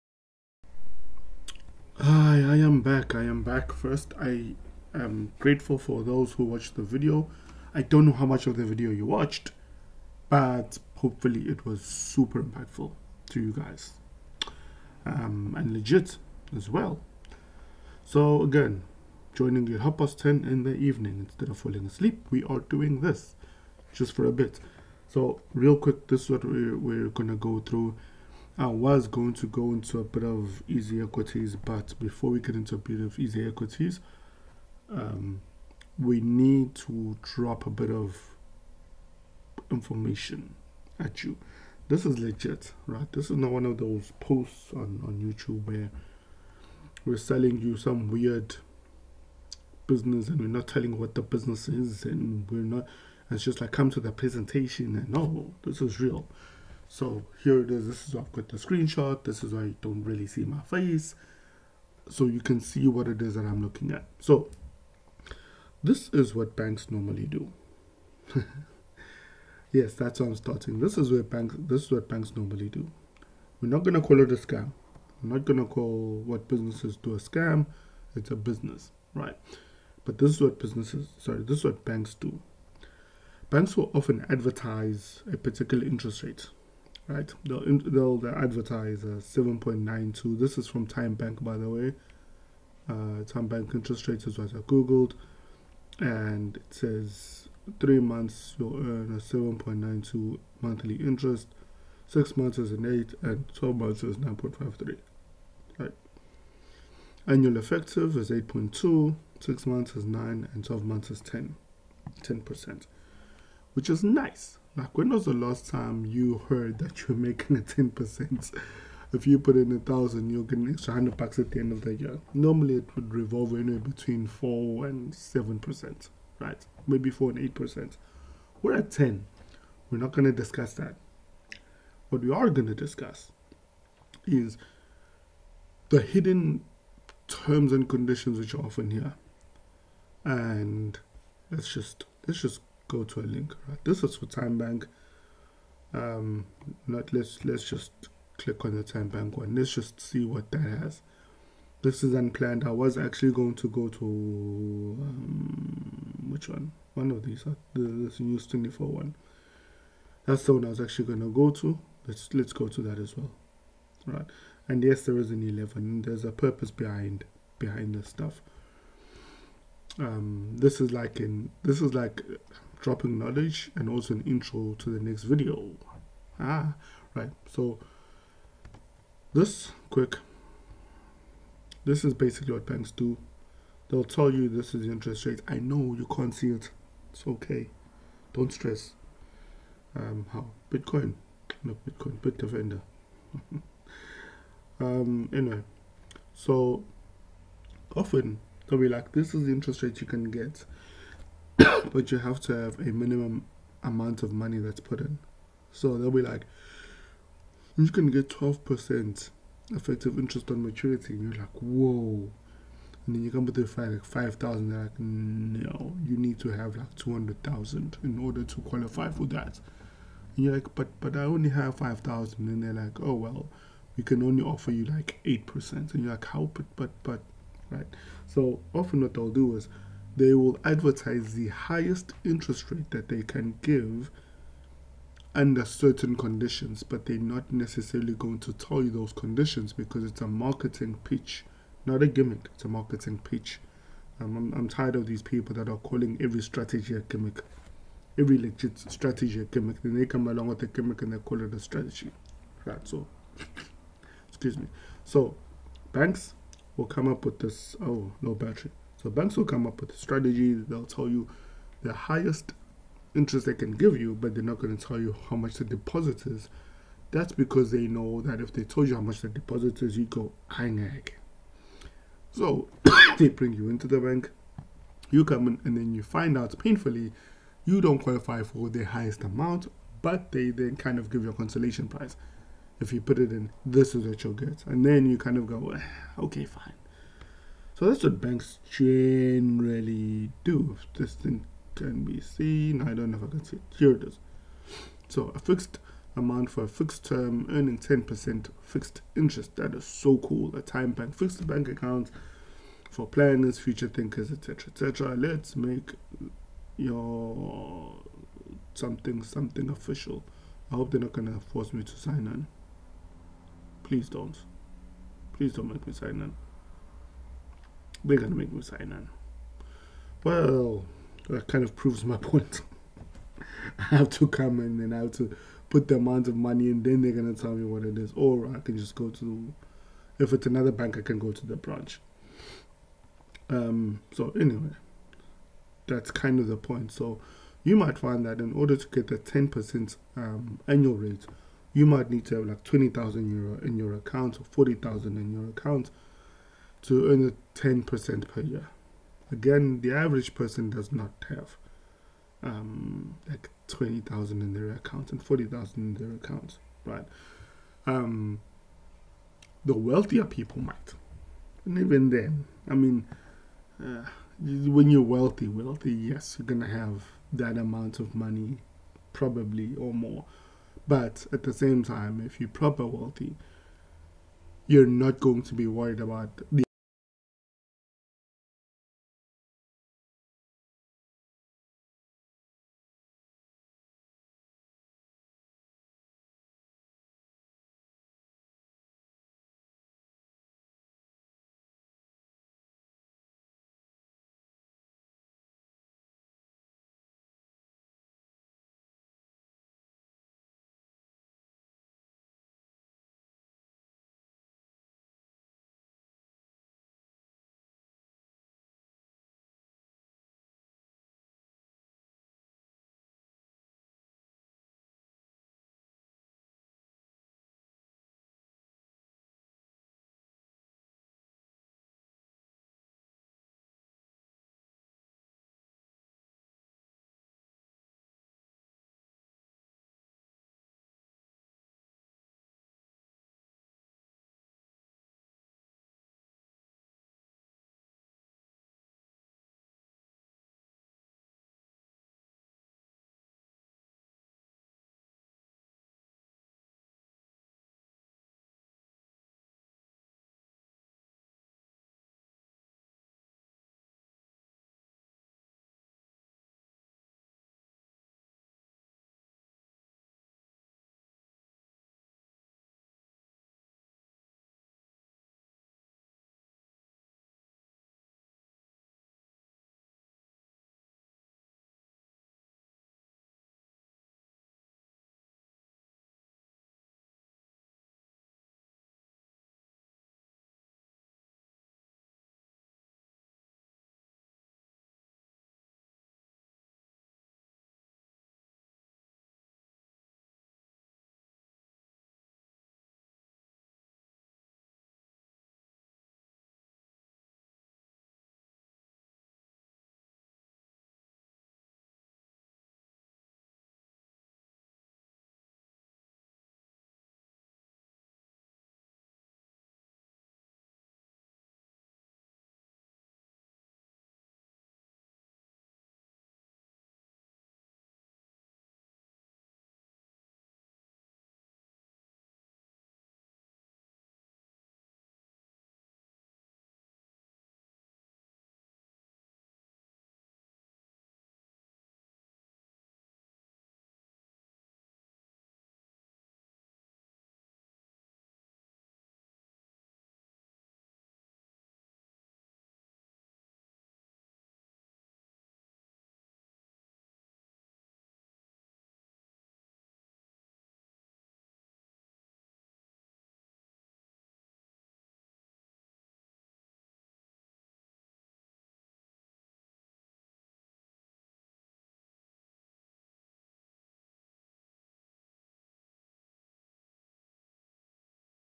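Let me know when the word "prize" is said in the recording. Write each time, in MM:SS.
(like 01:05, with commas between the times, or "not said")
04:41.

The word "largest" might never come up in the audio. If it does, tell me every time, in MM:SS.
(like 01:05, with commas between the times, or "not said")
not said.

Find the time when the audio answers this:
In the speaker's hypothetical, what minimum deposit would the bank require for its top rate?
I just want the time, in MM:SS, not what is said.
03:36.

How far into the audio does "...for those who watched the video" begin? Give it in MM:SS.
00:05.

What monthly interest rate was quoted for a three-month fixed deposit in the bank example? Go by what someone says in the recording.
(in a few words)
7.92.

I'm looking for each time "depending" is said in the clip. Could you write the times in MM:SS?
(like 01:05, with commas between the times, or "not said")
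not said.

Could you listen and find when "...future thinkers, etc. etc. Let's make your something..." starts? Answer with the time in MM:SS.
05:03.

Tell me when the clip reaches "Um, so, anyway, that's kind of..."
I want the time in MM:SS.
05:33.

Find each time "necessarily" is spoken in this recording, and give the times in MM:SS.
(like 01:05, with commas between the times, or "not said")
03:57.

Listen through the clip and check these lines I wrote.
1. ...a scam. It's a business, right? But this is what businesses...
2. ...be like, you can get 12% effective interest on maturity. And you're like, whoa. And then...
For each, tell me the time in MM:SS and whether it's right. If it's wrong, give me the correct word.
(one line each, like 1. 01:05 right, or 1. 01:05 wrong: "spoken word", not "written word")
1. 01:17 right
2. 03:26 right.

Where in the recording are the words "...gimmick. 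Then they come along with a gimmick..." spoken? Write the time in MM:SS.
04:09.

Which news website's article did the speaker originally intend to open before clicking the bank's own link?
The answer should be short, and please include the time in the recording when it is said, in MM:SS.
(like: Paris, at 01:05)
News24, at 02:38.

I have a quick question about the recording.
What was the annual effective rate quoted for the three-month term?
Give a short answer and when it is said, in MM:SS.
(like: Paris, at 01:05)
8.2, at 01:47.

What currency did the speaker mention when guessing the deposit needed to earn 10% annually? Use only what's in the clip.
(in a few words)
euro.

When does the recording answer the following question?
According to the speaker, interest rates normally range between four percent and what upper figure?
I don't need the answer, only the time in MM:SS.
02:05.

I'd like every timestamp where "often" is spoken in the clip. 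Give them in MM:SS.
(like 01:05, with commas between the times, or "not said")
01:23, 02:18, 03:17, 03:48.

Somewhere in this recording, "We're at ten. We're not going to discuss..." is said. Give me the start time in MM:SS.
02:08.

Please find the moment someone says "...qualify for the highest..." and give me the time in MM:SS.
04:37.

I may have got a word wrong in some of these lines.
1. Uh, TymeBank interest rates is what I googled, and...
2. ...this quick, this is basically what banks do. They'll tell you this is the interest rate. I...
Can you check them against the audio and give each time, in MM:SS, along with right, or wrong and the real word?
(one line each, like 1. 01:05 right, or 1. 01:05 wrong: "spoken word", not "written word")
1. 01:32 right
2. 02:59 right.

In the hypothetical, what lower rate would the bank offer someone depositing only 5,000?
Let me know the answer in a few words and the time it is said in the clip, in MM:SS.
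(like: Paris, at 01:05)
8%, at 03:45.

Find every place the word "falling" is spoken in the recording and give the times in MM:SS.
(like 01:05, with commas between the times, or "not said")
00:21.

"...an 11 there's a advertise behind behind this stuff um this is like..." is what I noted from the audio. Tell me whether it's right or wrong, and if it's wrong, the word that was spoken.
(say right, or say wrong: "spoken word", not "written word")
wrong: "purpose", not "advertise".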